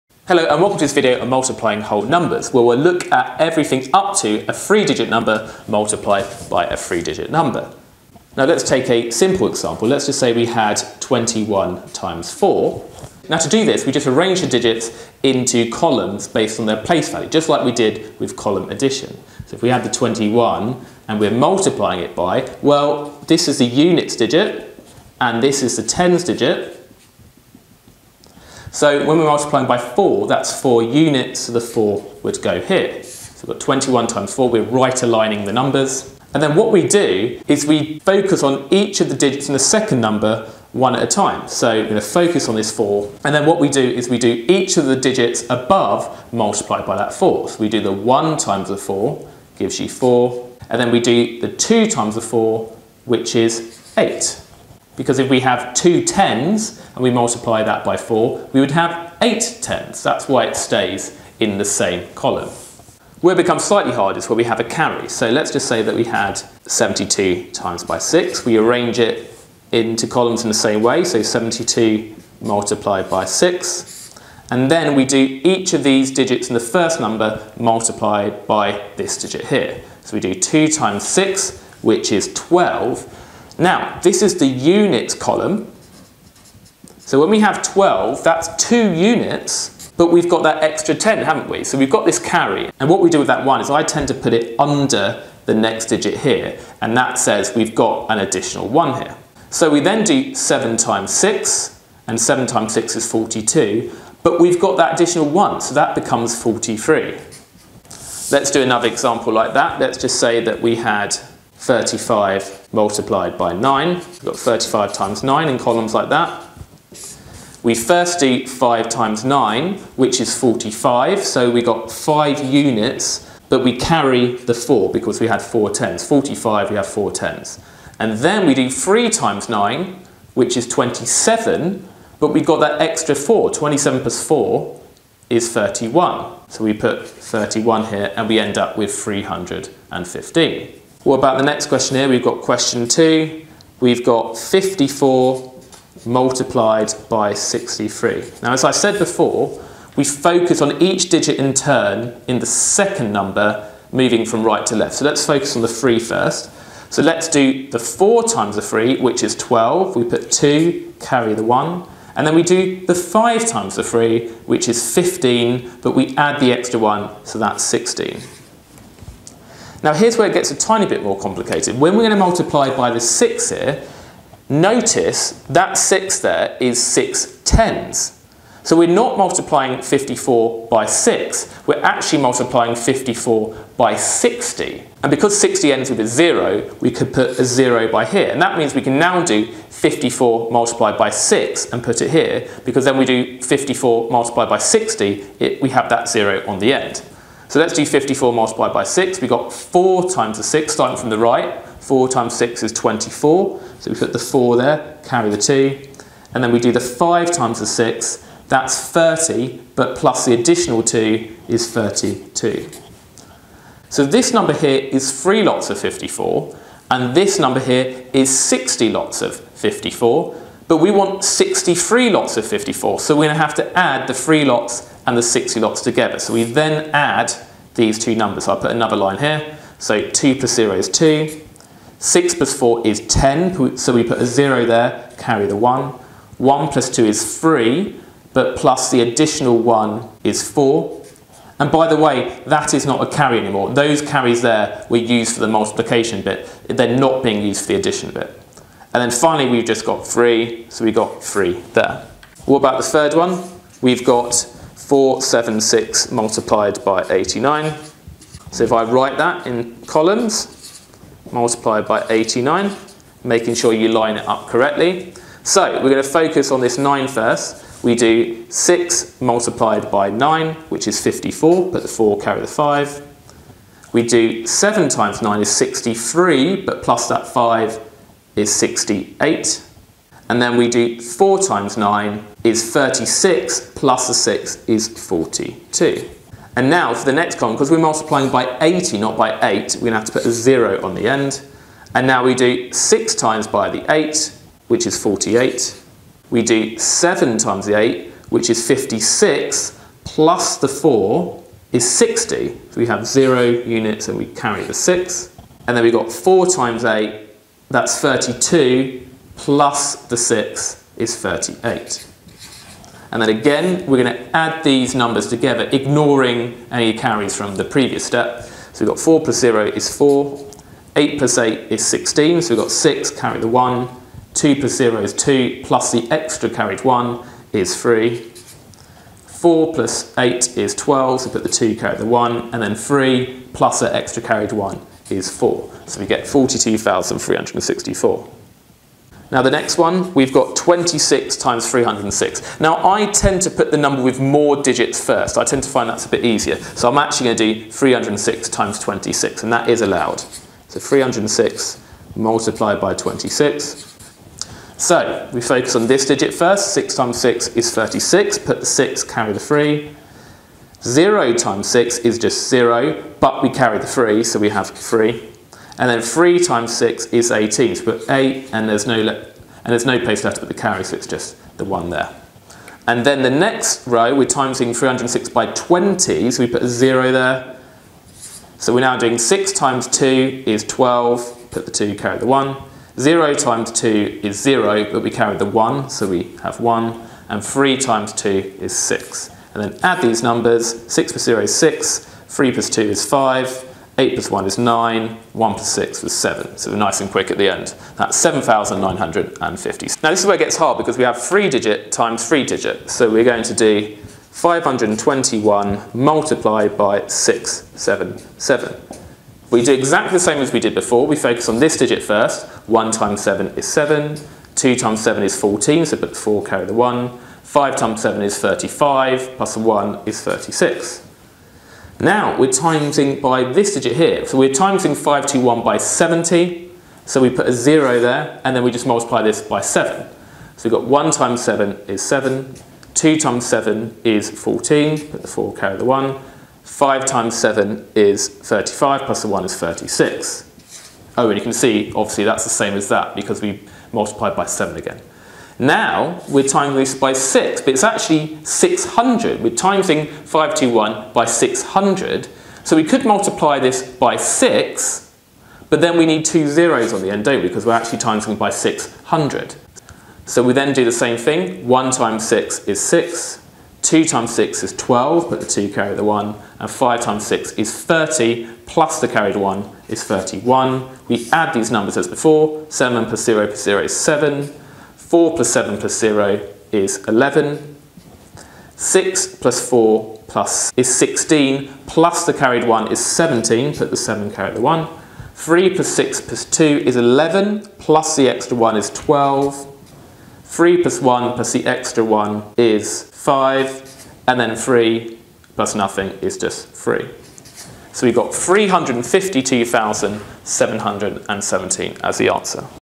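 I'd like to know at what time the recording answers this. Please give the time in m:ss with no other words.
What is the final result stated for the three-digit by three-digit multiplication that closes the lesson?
8:18.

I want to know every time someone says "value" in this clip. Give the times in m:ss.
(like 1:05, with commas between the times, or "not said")
0:17.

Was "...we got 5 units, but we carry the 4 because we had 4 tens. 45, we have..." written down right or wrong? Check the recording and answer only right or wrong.
right.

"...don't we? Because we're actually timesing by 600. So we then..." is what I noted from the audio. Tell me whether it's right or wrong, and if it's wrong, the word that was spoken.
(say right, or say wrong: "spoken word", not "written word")
right.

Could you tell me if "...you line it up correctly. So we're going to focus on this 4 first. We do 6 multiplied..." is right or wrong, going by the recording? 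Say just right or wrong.
wrong.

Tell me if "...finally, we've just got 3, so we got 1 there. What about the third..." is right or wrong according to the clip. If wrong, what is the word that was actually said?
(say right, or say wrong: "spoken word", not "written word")
wrong: "3", not "1".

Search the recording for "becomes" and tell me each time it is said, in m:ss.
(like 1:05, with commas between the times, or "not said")
1:03, 1:45.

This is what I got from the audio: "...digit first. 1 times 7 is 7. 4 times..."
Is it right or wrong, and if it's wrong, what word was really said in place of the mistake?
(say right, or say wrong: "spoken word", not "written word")
wrong: "2", not "4".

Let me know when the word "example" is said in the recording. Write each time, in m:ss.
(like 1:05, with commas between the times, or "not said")
0:09, 1:48.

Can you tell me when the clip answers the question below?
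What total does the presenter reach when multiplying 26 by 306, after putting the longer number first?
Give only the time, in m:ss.
6:38.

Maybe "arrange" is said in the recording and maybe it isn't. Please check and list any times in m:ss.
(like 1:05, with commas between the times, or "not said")
0:14, 1:08.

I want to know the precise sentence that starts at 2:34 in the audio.
So let's focus on the three first.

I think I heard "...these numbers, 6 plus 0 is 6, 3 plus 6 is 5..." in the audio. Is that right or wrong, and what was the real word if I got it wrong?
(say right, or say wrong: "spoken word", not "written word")
wrong: "2", not "6".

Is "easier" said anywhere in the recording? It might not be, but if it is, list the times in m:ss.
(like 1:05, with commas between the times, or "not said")
5:46.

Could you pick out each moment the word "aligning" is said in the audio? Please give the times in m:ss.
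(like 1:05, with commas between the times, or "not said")
0:35.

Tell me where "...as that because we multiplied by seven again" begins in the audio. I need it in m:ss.
7:22.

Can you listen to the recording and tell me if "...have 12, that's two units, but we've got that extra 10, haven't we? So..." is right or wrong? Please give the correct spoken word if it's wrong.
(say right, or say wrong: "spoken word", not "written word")
right.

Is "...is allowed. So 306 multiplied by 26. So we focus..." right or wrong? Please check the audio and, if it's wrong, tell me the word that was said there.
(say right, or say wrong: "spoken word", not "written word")
right.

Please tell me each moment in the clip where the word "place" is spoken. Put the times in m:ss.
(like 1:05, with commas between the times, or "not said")
0:16, 6:09.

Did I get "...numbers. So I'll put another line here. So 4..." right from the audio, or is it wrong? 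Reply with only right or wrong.
wrong.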